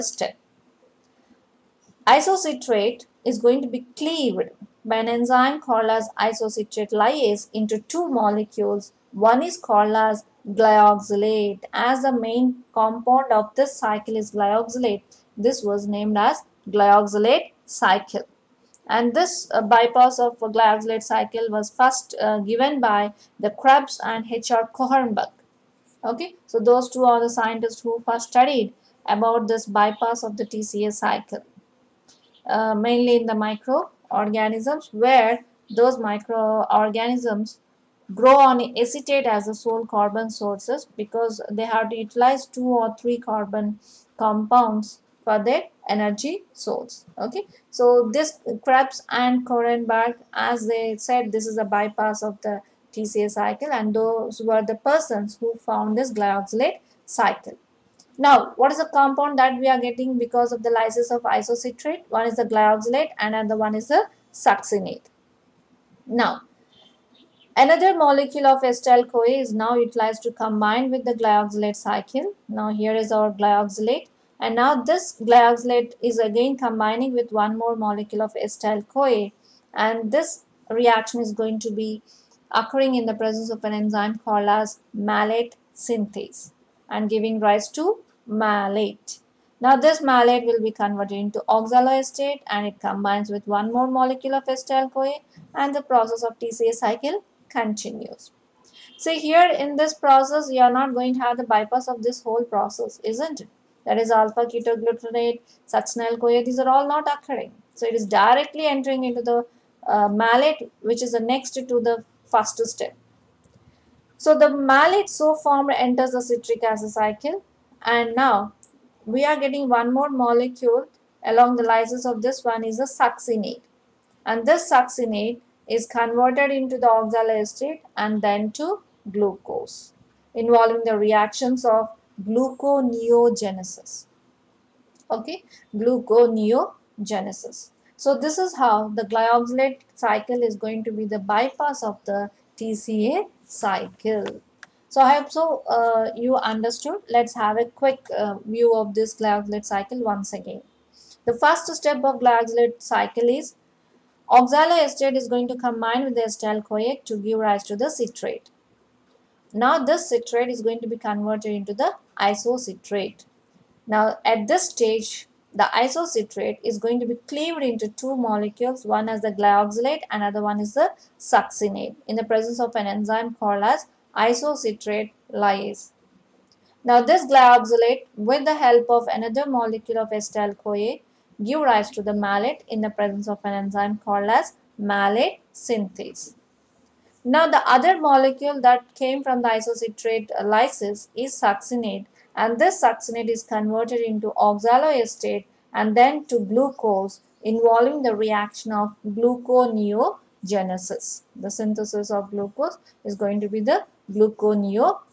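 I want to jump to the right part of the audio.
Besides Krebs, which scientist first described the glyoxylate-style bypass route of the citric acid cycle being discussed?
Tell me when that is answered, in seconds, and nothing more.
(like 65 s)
24 s.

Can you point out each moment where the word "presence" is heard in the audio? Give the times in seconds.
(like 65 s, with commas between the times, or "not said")
83 s, 172 s, 182 s.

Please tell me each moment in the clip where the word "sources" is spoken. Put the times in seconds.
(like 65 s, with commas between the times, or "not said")
40 s, 46 s.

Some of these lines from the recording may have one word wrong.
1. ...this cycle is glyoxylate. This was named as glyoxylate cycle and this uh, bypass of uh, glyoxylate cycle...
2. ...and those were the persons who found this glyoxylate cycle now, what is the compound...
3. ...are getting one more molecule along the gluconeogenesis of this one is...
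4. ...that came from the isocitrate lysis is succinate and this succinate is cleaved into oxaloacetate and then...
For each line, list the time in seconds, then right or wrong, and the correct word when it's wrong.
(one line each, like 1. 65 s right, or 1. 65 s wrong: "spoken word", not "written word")
1. 13 s right
2. 53 s right
3. 119 s wrong: "lysis", not "gluconeogenesis"
4. 188 s wrong: "converted", not "cleaved".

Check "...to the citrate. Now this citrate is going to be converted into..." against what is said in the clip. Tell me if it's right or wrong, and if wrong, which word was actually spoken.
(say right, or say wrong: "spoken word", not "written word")
right.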